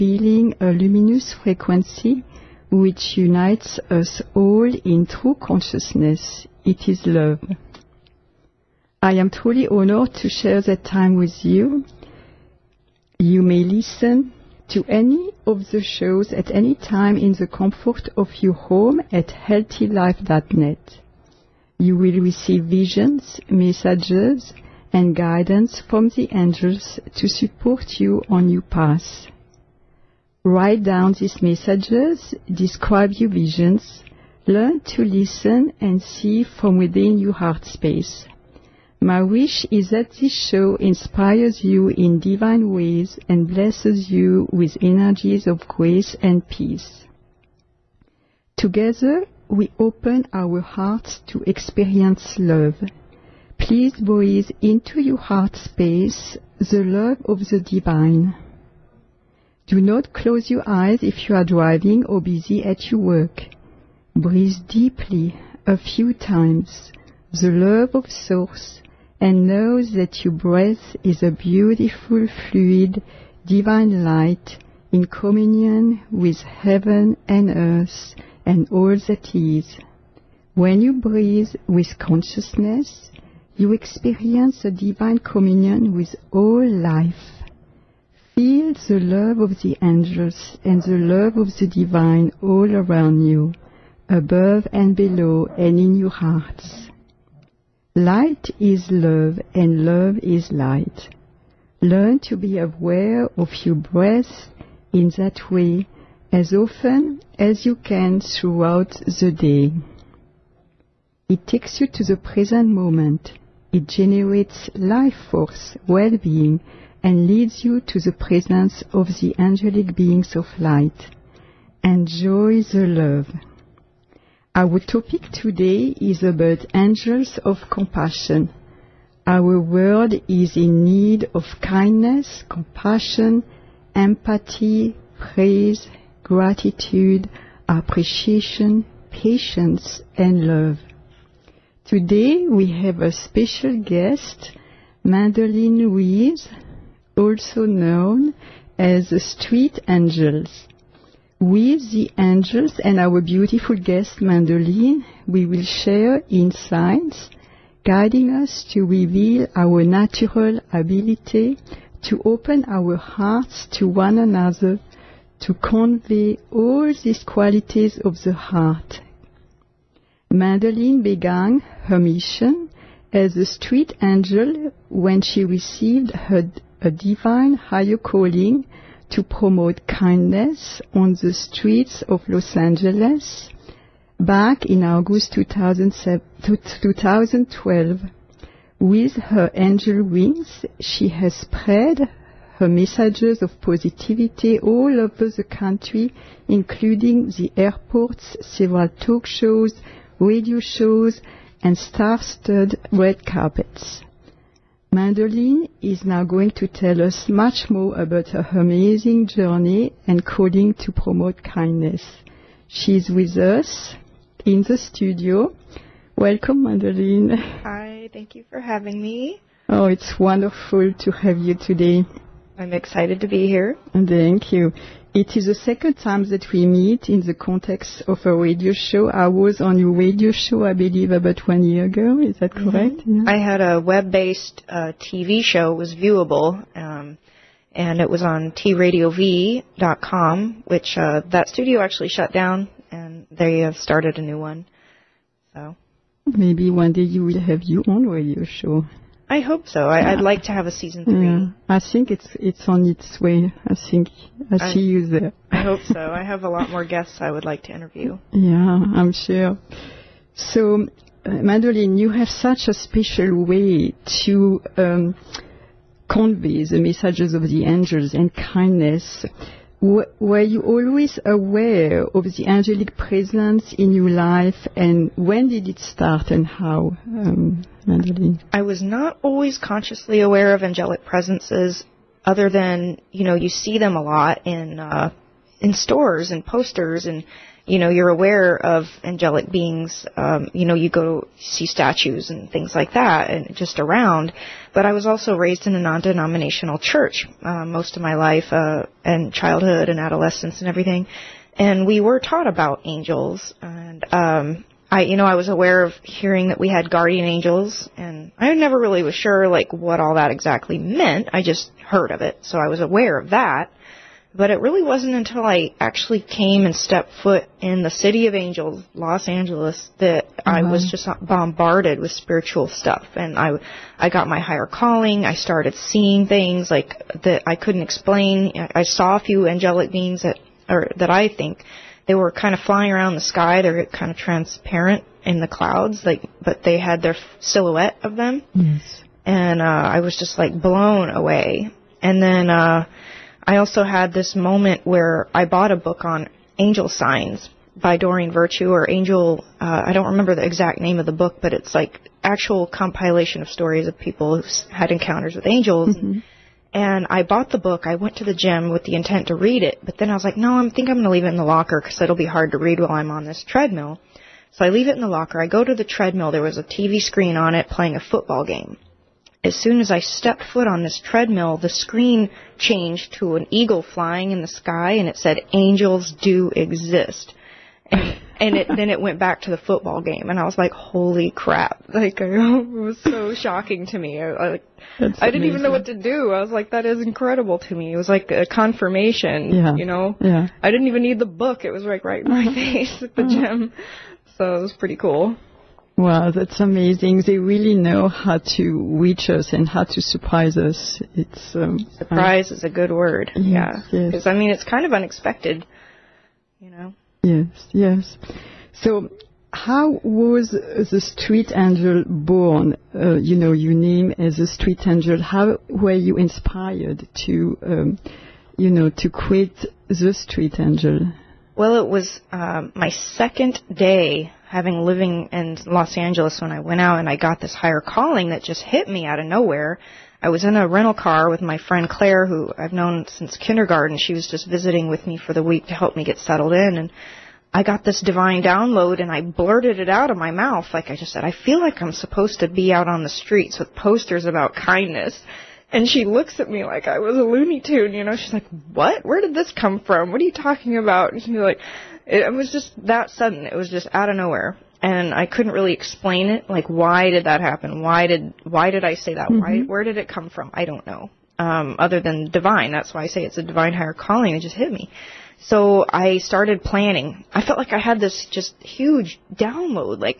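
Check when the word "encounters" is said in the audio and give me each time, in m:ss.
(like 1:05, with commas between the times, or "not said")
5:54.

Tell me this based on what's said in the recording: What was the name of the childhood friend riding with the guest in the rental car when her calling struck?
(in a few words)
Claire.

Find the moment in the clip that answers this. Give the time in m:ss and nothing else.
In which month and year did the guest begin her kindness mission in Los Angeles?
3:04.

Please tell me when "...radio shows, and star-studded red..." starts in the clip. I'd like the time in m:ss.
3:20.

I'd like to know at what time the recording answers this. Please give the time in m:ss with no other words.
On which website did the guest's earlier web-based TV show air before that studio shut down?
3:58.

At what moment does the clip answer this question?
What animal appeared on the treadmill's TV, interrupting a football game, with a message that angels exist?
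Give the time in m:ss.
6:13.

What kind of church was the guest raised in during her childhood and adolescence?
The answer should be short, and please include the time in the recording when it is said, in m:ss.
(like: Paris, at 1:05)
Non-denominational, at 4:55.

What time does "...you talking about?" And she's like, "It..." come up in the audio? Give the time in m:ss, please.
7:30.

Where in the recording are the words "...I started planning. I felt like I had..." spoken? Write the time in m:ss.
7:45.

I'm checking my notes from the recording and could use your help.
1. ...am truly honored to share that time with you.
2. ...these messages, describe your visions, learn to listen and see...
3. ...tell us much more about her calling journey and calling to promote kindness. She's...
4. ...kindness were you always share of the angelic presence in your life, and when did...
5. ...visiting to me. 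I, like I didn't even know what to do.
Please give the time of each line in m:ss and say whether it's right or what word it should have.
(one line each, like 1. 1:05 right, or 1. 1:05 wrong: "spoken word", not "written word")
1. 0:09 right
2. 0:31 right
3. 3:26 wrong: "amazing", not "calling"
4. 4:28 wrong: "aware", not "share"
5. 6:23 wrong: "shocking", not "visiting".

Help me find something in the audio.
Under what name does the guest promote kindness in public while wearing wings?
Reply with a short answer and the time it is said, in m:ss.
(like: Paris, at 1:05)
Street Angels, at 2:29.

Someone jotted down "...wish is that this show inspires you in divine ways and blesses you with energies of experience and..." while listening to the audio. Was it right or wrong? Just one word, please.
wrong.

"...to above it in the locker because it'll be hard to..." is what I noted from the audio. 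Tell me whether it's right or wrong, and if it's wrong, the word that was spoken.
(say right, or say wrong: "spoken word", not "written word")
wrong: "leave", not "above".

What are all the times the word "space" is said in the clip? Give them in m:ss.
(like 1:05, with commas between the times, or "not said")
0:37, 0:55.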